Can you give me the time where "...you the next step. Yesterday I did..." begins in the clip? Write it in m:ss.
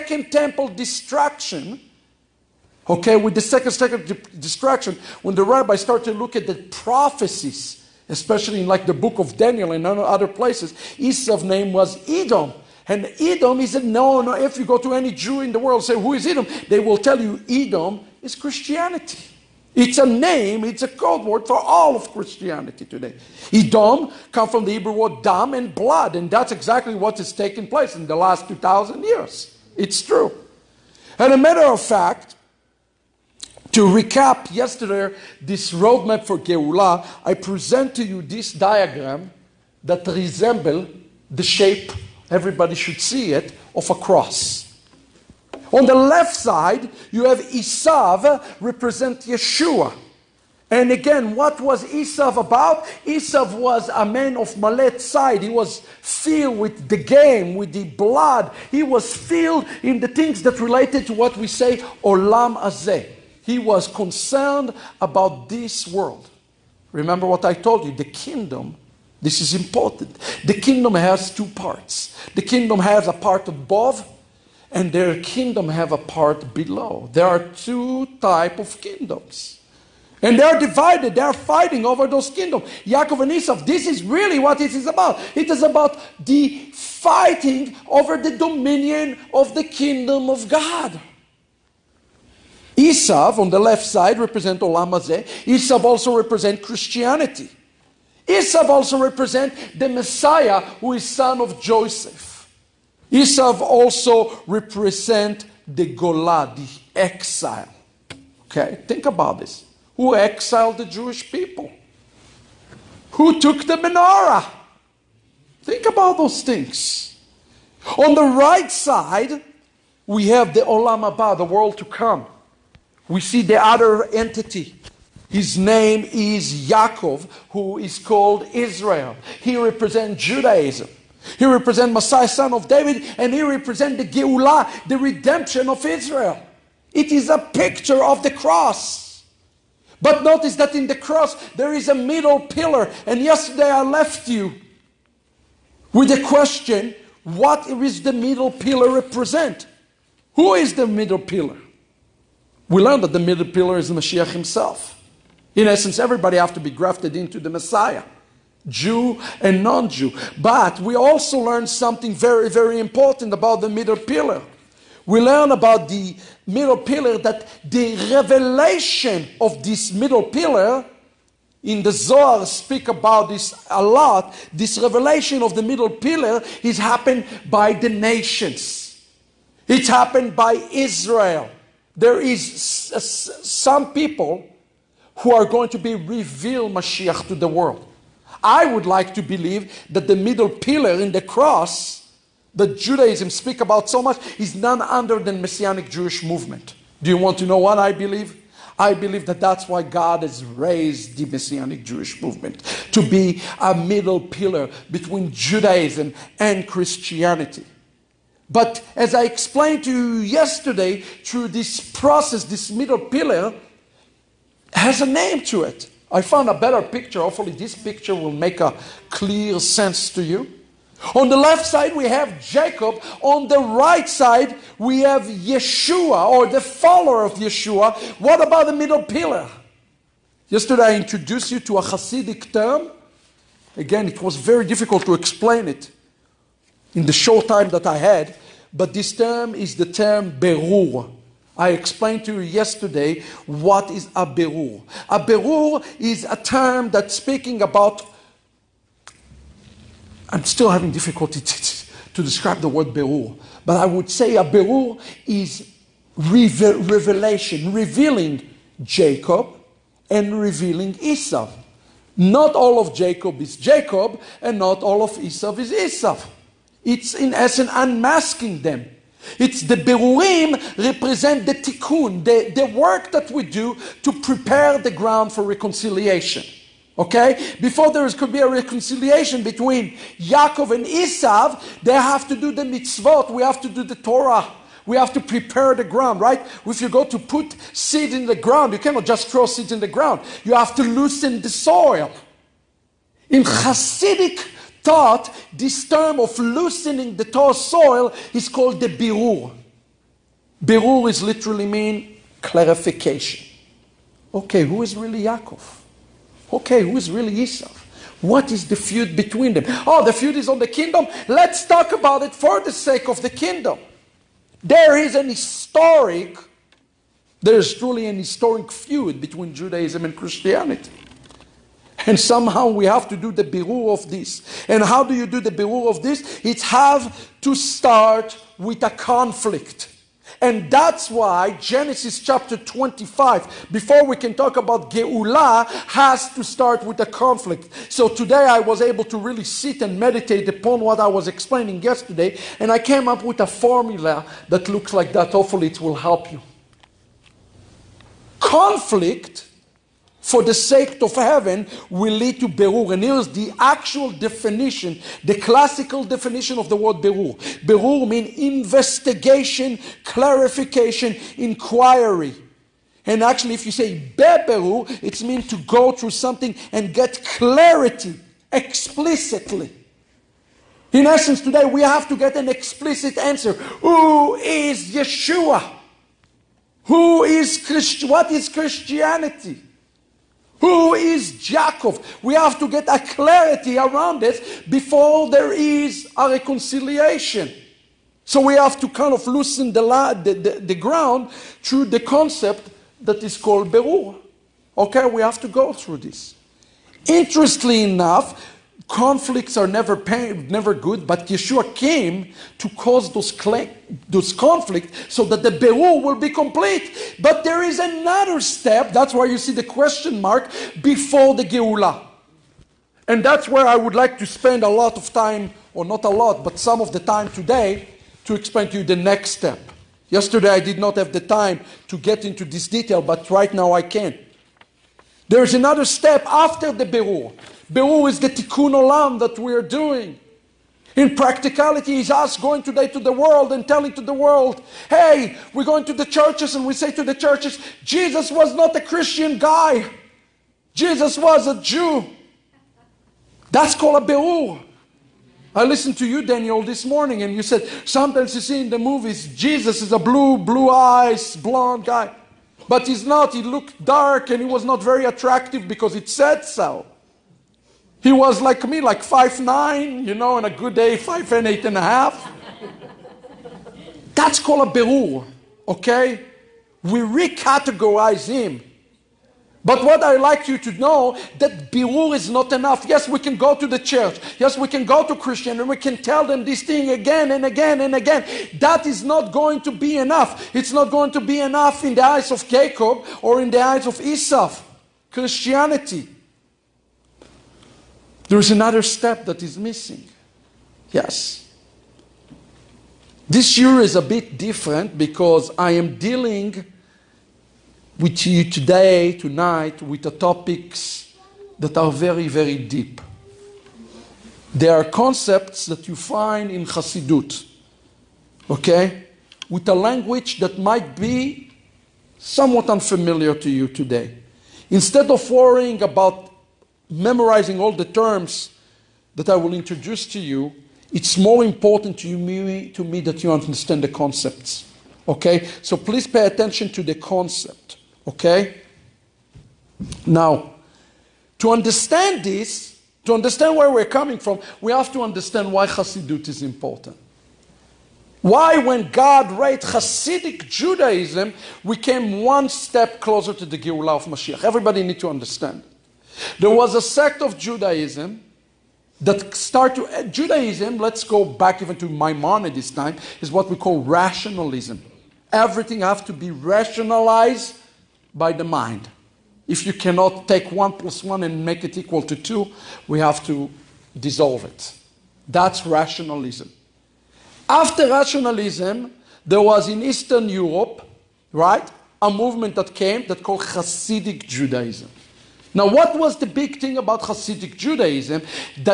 6:58.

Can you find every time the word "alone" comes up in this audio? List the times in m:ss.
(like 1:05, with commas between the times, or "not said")
not said.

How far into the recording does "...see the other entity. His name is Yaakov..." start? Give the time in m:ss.
2:03.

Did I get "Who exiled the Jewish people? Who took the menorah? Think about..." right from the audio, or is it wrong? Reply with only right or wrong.
right.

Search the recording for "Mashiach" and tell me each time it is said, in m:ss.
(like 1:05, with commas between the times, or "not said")
2:33, 3:06, 9:04.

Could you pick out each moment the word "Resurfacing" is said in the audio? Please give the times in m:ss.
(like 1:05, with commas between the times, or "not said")
not said.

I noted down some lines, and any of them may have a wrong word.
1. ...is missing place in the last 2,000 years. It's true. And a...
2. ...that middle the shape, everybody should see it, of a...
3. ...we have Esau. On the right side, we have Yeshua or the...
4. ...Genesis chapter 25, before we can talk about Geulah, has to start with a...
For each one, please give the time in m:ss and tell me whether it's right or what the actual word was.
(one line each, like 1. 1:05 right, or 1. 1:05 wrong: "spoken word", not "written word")
1. 0:27 wrong: "taking", not "missing"
2. 0:39 wrong: "resemble", not "middle"
3. 3:41 wrong: "Jacob", not "Esau"
4. 5:31 right.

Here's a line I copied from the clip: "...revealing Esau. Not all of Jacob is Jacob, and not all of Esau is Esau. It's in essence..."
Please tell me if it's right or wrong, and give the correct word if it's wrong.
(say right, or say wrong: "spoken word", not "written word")
right.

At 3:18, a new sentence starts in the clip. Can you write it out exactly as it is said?
I believe that that's why God has raised the Messianic Jewish movement to be a middle pillar between Judaism and Christianity.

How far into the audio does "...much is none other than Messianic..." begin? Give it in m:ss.
3:14.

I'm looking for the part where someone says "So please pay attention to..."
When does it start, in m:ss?
8:45.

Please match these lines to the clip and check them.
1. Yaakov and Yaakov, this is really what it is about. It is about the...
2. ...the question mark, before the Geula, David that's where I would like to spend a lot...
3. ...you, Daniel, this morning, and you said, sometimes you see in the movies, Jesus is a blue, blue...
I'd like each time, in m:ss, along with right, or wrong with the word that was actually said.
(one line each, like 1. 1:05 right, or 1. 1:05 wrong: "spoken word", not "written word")
1. 1:22 wrong: "Esau", not "Yaakov"
2. 6:49 wrong: "And", not "David"
3. 7:26 right.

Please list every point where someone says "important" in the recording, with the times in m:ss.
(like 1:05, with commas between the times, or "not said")
1:09, 2:42, 8:41, 8:56.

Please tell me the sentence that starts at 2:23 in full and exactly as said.
And yesterday I left you with a question what is the middle pillar represent?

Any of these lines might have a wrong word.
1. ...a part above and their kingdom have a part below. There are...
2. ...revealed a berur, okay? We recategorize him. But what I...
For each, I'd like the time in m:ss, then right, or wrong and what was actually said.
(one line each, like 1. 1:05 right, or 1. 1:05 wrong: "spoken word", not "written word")
1. 1:13 right
2. 7:44 wrong: "called", not "revealed".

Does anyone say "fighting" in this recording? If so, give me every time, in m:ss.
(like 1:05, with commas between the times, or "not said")
1:21, 1:26.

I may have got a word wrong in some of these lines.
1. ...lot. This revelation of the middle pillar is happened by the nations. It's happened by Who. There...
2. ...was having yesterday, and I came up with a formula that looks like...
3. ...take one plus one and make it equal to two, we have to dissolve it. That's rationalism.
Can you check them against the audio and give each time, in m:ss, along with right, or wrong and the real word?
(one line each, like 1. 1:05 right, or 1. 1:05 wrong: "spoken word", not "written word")
1. 2:53 wrong: "Israel", not "Who"
2. 5:41 wrong: "explaining", not "having"
3. 9:20 right.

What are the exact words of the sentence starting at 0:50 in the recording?
And again, what was Esav about?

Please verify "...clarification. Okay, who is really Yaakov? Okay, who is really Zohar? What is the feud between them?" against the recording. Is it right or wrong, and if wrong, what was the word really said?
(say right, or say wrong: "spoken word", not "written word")
wrong: "Esau", not "Zohar".